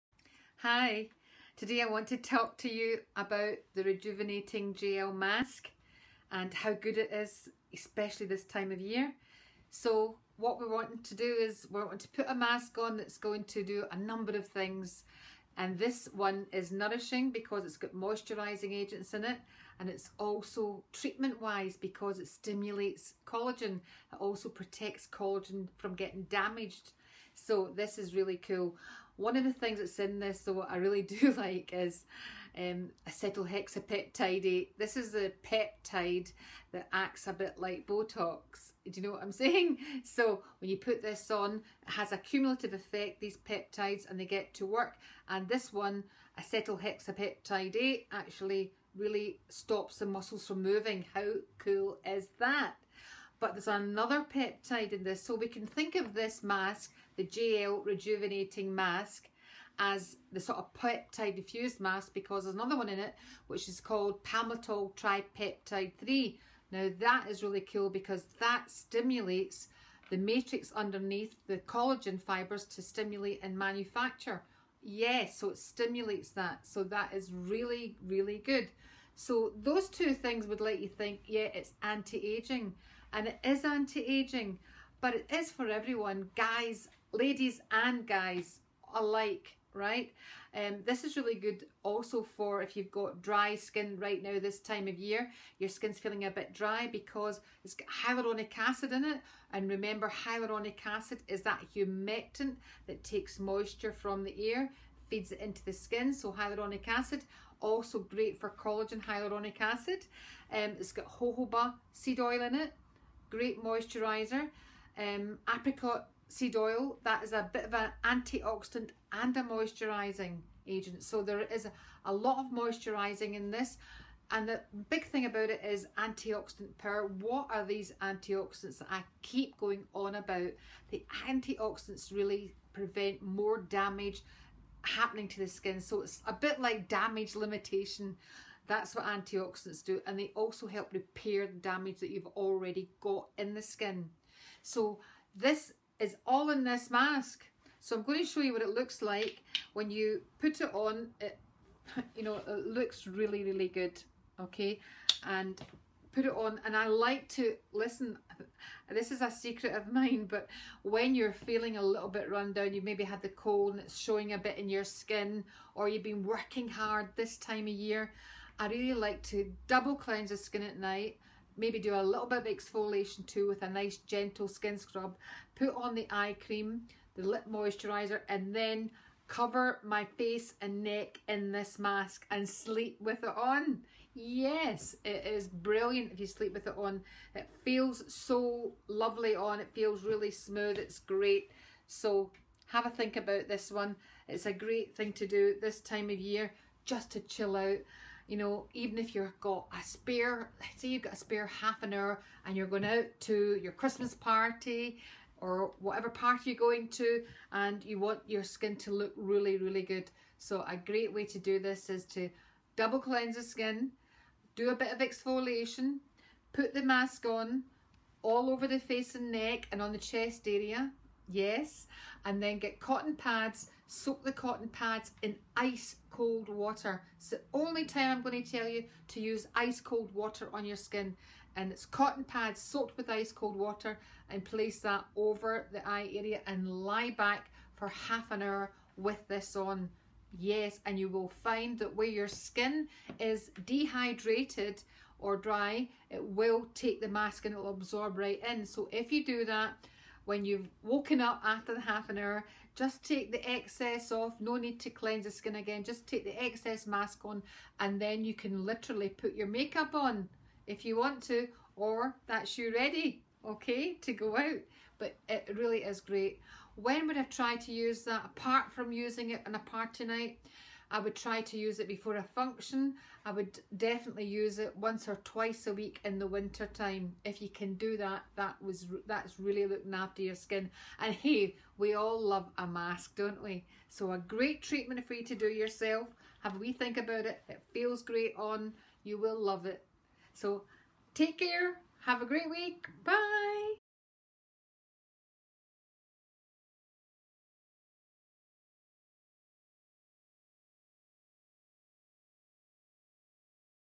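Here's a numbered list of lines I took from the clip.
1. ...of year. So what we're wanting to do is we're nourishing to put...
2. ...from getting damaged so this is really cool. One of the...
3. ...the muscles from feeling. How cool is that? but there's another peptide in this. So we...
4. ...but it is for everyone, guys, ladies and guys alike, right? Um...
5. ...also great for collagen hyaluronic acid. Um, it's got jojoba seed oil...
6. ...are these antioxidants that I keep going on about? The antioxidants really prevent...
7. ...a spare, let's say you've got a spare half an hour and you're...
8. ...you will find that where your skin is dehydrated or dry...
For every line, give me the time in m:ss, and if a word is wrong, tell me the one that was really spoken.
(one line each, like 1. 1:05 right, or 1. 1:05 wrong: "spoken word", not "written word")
1. 0:08 wrong: "wanting", not "nourishing"
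2. 0:25 right
3. 0:49 wrong: "moving", not "feeling"
4. 1:25 right
5. 1:47 right
6. 2:07 right
7. 3:19 right
8. 4:00 right.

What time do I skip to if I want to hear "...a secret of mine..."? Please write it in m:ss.
2:39.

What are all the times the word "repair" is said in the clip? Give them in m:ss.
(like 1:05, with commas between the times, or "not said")
2:20.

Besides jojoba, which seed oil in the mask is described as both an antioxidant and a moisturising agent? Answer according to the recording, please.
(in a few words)
apricot seed oil.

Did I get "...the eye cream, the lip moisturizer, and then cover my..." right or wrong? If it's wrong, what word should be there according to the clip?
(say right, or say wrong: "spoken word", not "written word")
right.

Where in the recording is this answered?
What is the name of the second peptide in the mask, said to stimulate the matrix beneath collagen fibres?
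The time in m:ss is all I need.
1:04.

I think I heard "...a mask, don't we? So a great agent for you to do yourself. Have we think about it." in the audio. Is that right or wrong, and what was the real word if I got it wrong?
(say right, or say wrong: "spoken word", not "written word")
wrong: "treatment", not "agent".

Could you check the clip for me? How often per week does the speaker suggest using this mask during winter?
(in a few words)
once or twice.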